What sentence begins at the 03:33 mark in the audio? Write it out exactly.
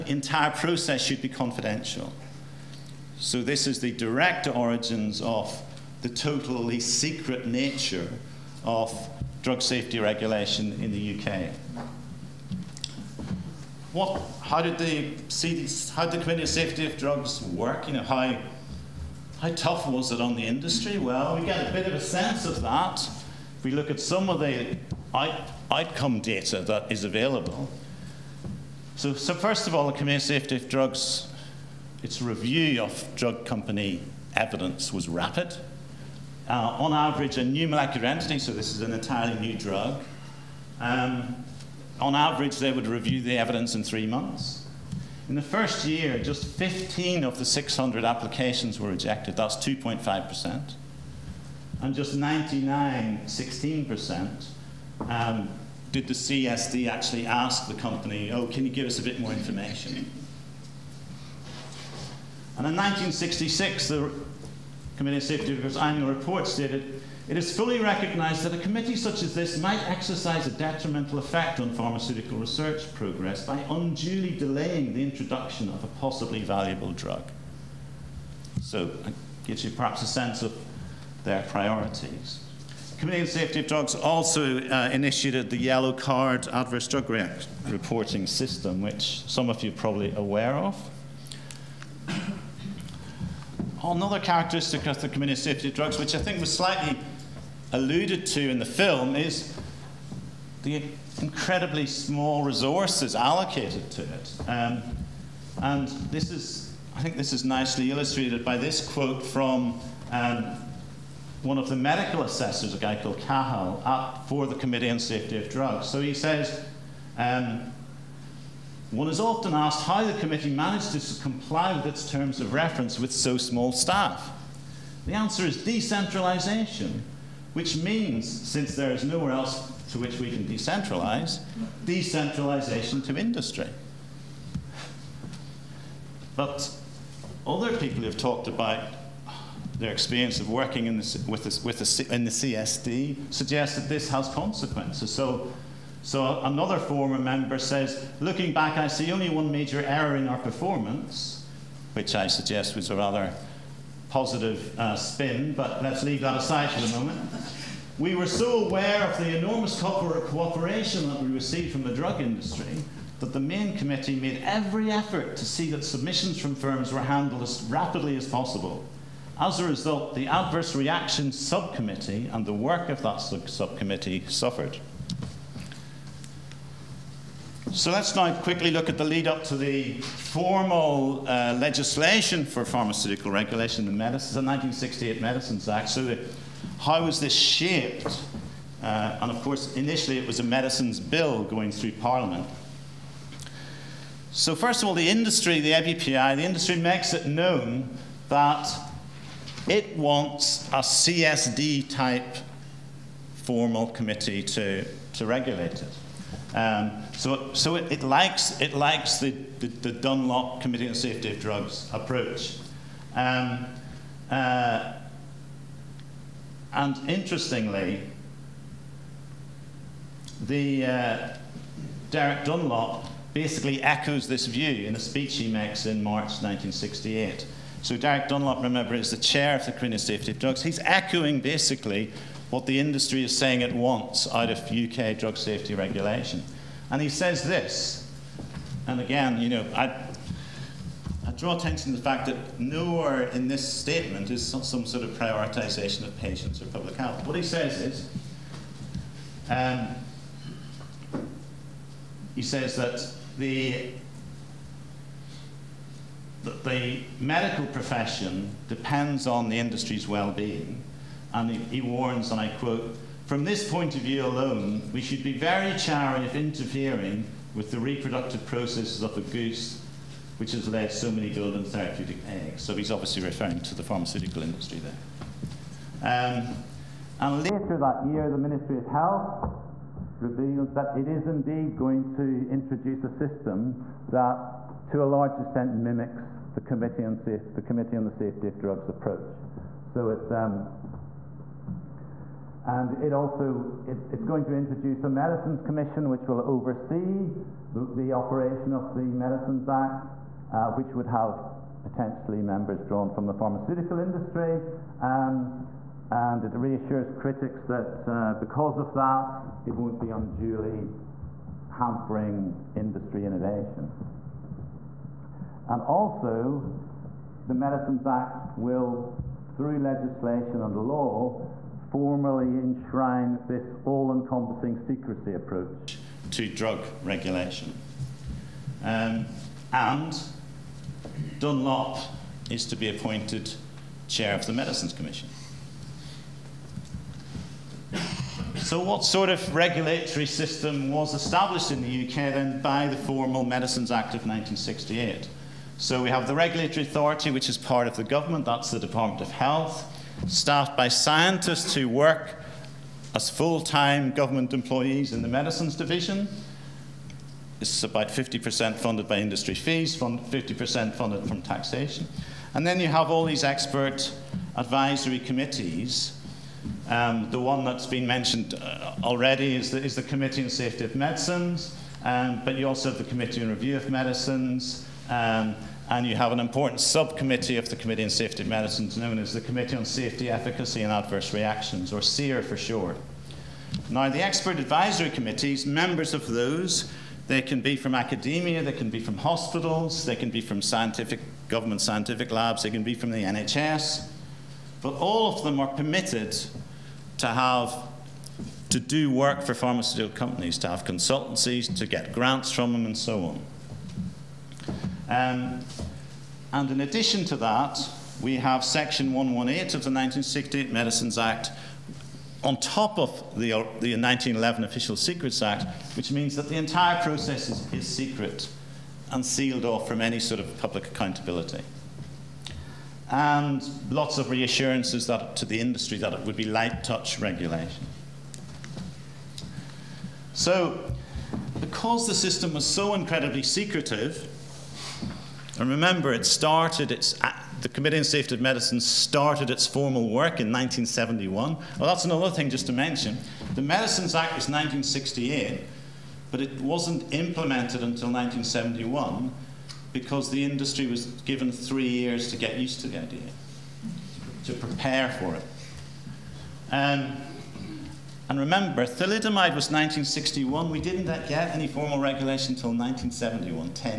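Um, uh, and interestingly, the uh, Derek Dunlop basically echoes this view in a speech he makes in March 1968.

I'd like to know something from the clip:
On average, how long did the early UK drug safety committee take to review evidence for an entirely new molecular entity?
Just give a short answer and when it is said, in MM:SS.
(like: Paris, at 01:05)
3 months, at 00:43.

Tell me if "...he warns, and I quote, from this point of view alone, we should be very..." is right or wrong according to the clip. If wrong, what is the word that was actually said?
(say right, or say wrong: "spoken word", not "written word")
right.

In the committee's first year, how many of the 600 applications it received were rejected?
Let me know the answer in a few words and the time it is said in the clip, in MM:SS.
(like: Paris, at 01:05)
15, at 00:46.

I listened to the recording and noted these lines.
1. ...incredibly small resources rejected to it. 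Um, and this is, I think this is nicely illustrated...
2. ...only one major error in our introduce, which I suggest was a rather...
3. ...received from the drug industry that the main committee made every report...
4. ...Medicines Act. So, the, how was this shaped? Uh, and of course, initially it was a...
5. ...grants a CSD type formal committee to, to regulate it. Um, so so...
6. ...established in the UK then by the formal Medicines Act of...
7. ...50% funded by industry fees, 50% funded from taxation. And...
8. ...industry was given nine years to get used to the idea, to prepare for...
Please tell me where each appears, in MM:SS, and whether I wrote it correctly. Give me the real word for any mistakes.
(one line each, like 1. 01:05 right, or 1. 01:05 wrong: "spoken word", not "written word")
1. 01:41 wrong: "allocated", not "rejected"
2. 02:29 wrong: "performance", not "introduce"
3. 02:41 wrong: "effort", not "report"
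4. 03:05 right
5. 03:19 wrong: "wants", not "grants"
6. 05:41 right
7. 05:58 right
8. 07:30 wrong: "three", not "nine".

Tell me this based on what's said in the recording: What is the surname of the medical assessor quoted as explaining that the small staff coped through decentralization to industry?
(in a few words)
Cahill.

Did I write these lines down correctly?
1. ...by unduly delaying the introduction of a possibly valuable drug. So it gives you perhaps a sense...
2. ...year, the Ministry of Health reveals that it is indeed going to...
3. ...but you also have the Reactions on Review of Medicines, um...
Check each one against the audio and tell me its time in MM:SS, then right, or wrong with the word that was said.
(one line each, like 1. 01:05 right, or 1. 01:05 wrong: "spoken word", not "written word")
1. 01:13 right
2. 04:38 right
3. 06:12 wrong: "Committee", not "Reactions".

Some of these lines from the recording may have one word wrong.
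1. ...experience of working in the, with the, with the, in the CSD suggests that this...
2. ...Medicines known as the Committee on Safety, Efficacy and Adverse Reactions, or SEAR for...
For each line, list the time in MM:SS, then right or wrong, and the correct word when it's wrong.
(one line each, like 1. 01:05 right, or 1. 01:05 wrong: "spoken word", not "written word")
1. 02:19 right
2. 06:18 right.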